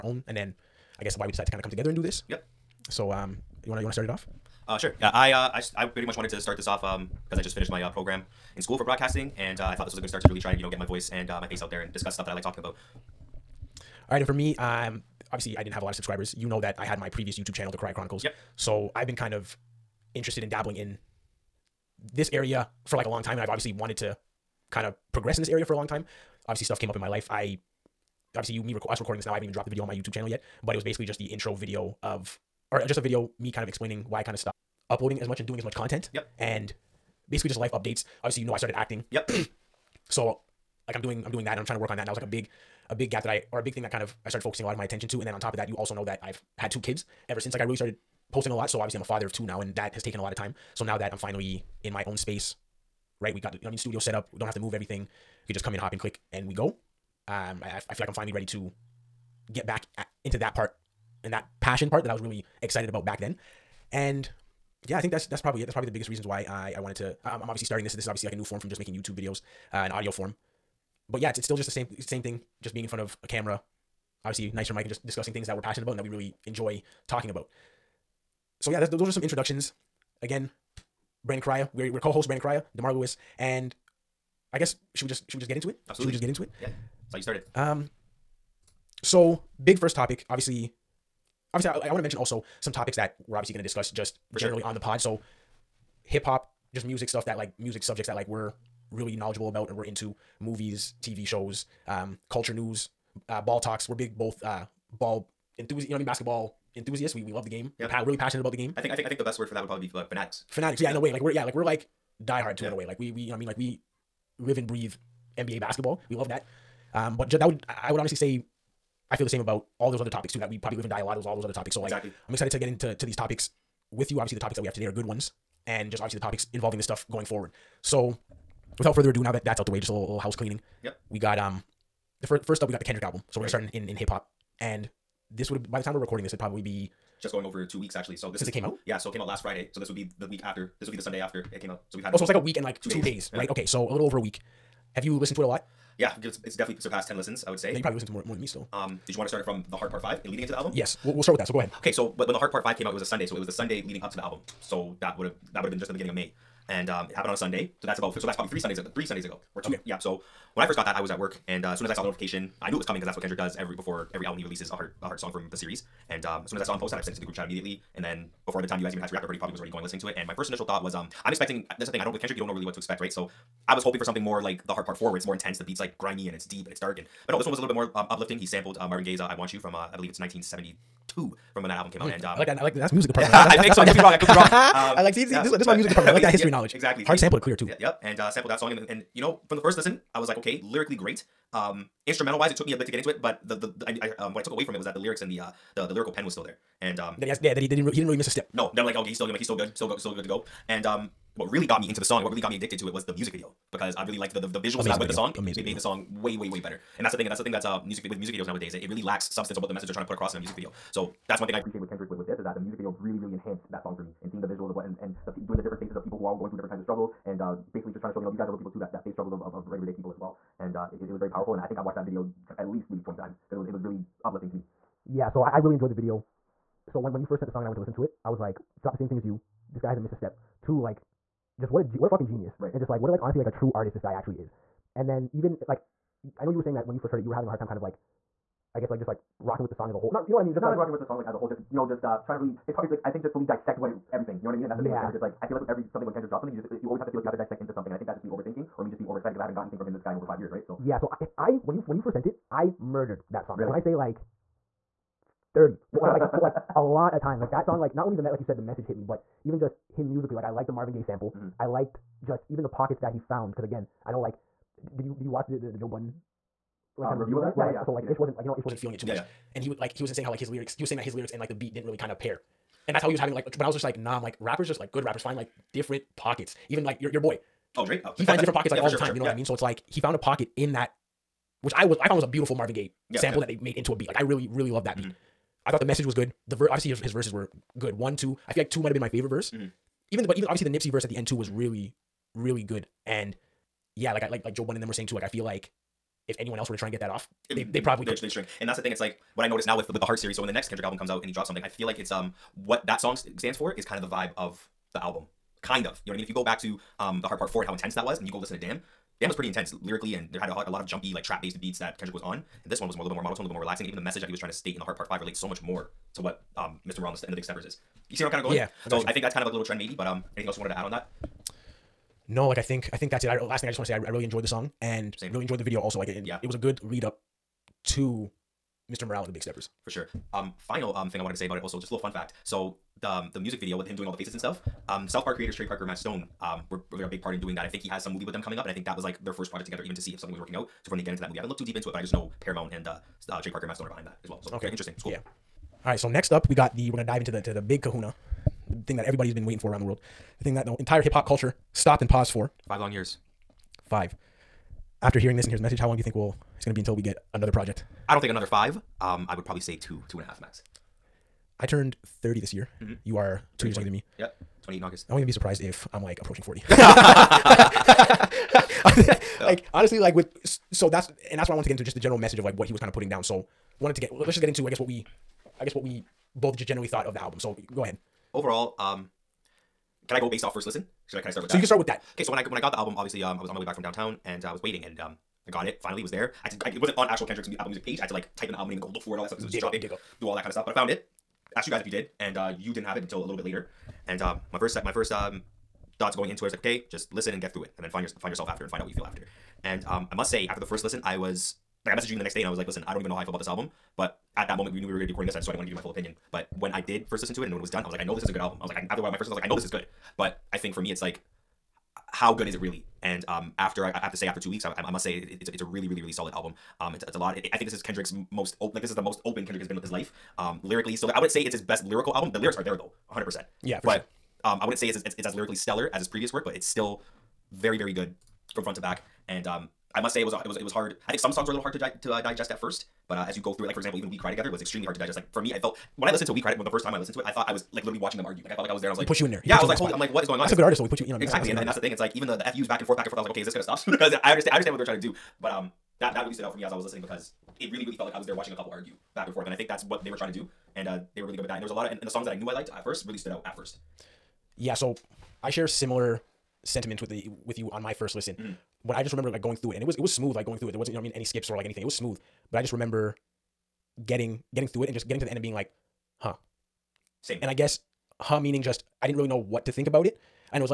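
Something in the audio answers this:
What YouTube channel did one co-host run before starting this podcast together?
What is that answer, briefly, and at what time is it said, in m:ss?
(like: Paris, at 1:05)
The Correia Chronicles, at 0:17.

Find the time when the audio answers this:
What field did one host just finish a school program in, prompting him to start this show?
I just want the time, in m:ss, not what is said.
0:08.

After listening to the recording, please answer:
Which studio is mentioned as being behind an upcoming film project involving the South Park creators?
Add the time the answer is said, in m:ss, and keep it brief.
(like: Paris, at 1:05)
Paramount, at 5:42.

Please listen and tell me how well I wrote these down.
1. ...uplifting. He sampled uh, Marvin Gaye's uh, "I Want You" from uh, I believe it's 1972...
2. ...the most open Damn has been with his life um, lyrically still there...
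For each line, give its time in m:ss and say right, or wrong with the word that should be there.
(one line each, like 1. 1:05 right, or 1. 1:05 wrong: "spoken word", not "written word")
1. 2:58 right
2. 6:58 wrong: "Kendrick", not "Damn".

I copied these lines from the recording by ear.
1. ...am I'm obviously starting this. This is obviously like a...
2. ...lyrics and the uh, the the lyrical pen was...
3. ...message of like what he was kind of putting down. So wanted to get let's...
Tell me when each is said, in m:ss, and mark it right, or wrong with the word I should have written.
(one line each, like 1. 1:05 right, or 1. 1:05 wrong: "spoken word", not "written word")
1. 1:07 right
2. 3:14 right
3. 6:12 right.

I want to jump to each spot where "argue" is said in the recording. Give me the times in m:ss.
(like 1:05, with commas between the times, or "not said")
7:18, 7:28.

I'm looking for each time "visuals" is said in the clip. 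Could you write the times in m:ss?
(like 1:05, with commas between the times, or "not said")
3:24, 3:34.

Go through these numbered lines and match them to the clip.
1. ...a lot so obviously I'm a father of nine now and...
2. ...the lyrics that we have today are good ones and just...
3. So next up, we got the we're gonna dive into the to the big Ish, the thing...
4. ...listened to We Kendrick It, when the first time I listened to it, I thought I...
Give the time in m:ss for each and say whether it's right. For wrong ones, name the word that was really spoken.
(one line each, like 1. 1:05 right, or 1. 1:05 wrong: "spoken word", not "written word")
1. 0:48 wrong: "two", not "nine"
2. 2:04 wrong: "topics", not "lyrics"
3. 5:45 wrong: "Kahuna", not "Ish"
4. 7:16 wrong: "Cried", not "Kendrick".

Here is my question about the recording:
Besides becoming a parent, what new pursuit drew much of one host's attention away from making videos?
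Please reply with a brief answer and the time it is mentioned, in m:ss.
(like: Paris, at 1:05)
Acting, at 0:38.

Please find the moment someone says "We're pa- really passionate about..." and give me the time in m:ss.
1:47.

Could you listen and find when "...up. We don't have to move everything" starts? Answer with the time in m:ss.
0:54.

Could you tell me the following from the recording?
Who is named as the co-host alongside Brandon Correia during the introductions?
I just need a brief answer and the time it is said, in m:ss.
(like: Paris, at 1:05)
Demar Lewis, at 1:22.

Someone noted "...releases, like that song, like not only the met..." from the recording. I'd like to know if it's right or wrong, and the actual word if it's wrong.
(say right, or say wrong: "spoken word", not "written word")
wrong: "times", not "releases".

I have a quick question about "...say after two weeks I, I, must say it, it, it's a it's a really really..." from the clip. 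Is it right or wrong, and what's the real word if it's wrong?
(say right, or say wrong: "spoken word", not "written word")
right.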